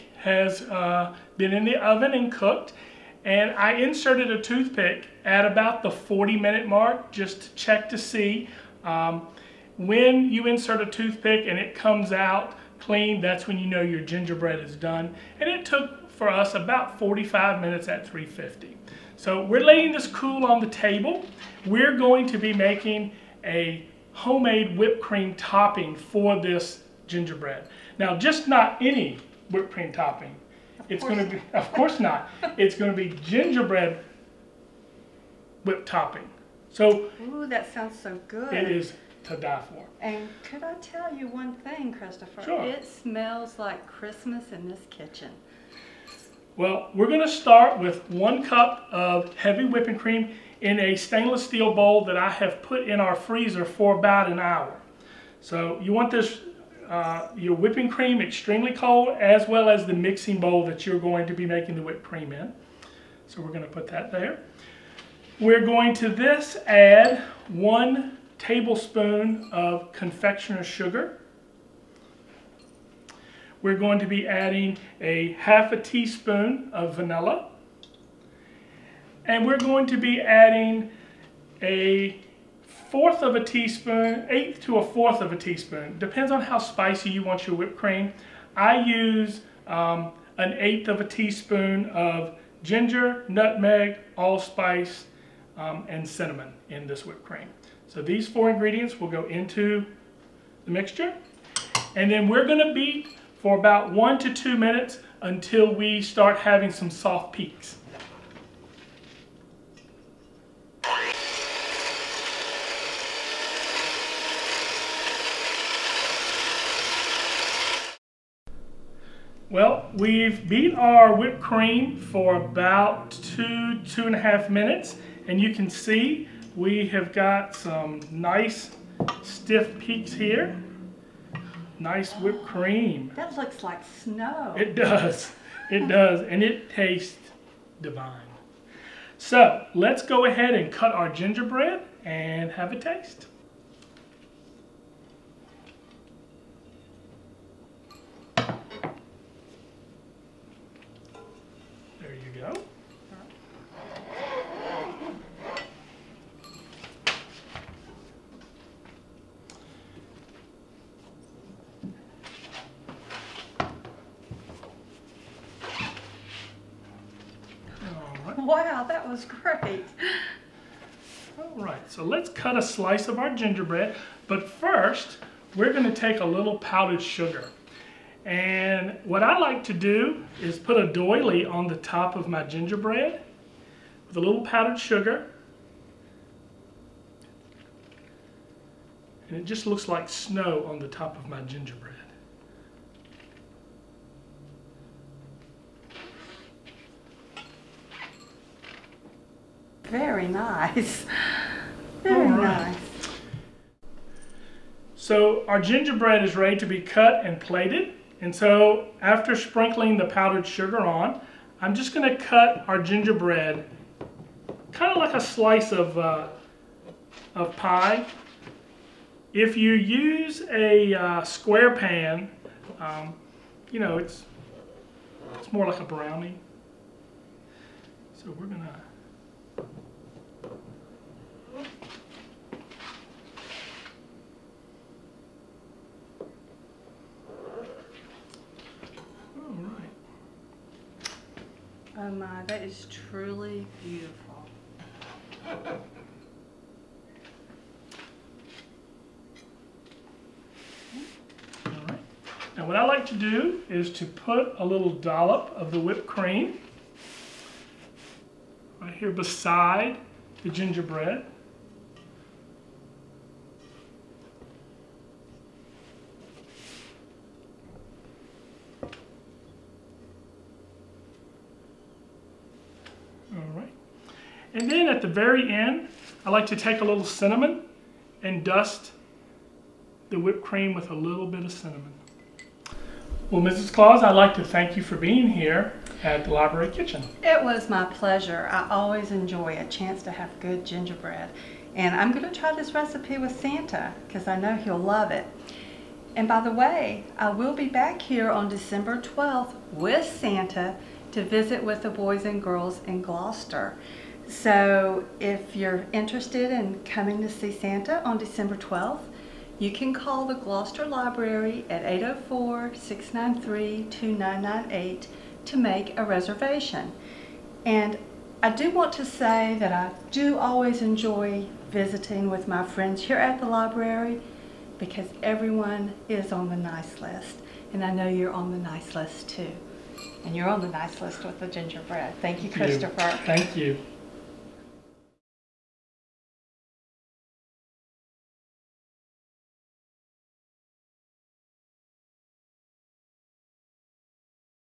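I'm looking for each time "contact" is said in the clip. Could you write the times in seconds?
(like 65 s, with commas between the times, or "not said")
not said.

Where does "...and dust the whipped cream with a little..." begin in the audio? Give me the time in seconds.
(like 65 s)
278 s.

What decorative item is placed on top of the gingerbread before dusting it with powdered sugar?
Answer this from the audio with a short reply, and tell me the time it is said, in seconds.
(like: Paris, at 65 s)
a doily, at 180 s.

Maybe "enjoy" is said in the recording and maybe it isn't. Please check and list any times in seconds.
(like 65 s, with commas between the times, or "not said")
289 s, 320 s.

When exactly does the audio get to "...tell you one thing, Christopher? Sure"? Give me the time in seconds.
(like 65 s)
40 s.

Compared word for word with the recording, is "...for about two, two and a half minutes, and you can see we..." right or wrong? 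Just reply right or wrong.
right.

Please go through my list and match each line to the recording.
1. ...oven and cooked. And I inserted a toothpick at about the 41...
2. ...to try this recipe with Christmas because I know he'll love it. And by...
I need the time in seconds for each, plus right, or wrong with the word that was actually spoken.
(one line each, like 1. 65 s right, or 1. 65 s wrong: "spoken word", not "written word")
1. 1 s wrong: "40", not "41"
2. 292 s wrong: "Santa", not "Christmas".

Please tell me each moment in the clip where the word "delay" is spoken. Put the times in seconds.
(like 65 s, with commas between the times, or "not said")
not said.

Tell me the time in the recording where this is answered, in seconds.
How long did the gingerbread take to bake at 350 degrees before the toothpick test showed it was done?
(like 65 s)
16 s.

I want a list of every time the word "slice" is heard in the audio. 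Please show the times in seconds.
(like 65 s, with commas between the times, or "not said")
172 s, 215 s.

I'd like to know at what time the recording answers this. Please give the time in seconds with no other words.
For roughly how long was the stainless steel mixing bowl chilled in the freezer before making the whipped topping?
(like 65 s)
53 s.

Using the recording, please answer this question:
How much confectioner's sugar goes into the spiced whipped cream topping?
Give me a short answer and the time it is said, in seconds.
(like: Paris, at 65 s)
1 tablespoon, at 67 s.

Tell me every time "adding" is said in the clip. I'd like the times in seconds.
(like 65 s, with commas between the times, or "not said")
74 s, 80 s.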